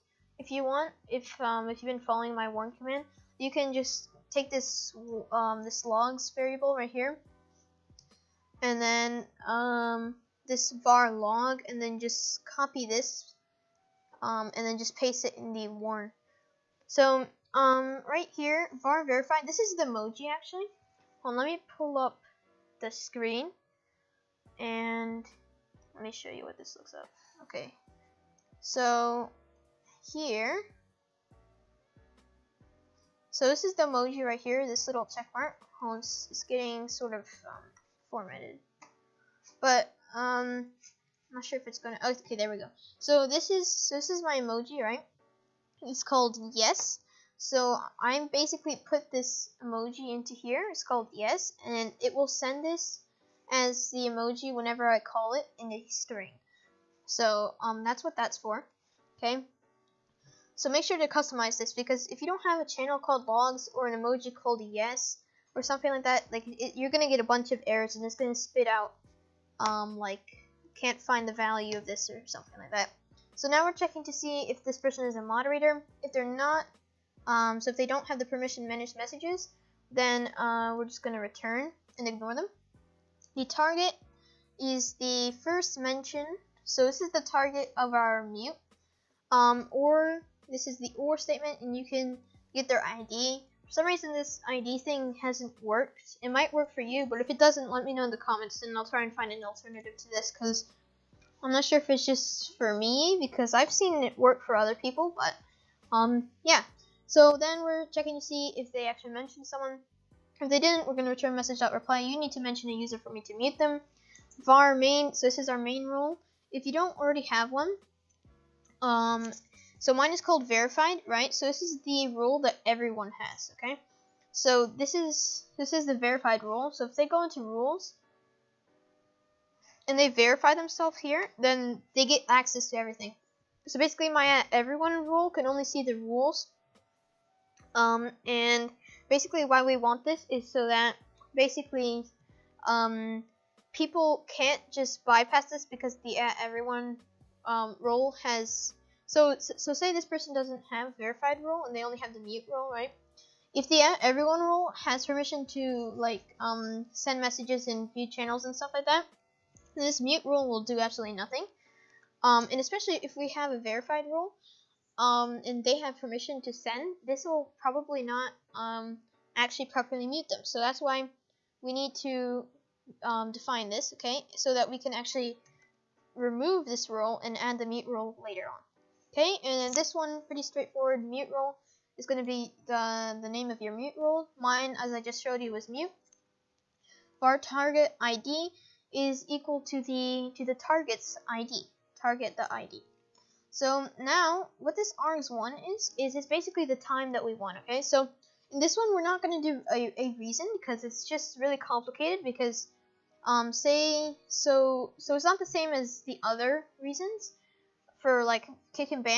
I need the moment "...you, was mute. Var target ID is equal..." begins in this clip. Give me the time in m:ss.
3:05.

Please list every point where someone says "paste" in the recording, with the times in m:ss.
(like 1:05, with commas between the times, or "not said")
0:14.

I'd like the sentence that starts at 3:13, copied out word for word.
So now, what this args1 is, is it's basically the time that we want, okay?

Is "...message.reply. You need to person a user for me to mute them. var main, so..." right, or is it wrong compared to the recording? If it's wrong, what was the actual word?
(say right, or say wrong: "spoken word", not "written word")
wrong: "mention", not "person".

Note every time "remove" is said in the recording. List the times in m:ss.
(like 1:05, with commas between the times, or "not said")
2:56.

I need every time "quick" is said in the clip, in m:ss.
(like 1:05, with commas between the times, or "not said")
not said.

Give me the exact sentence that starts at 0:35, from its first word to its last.
It's, it's getting sort of um, formatted.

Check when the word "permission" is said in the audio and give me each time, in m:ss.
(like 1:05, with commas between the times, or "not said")
1:18, 2:35, 2:45.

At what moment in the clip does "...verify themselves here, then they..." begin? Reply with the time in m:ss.
2:10.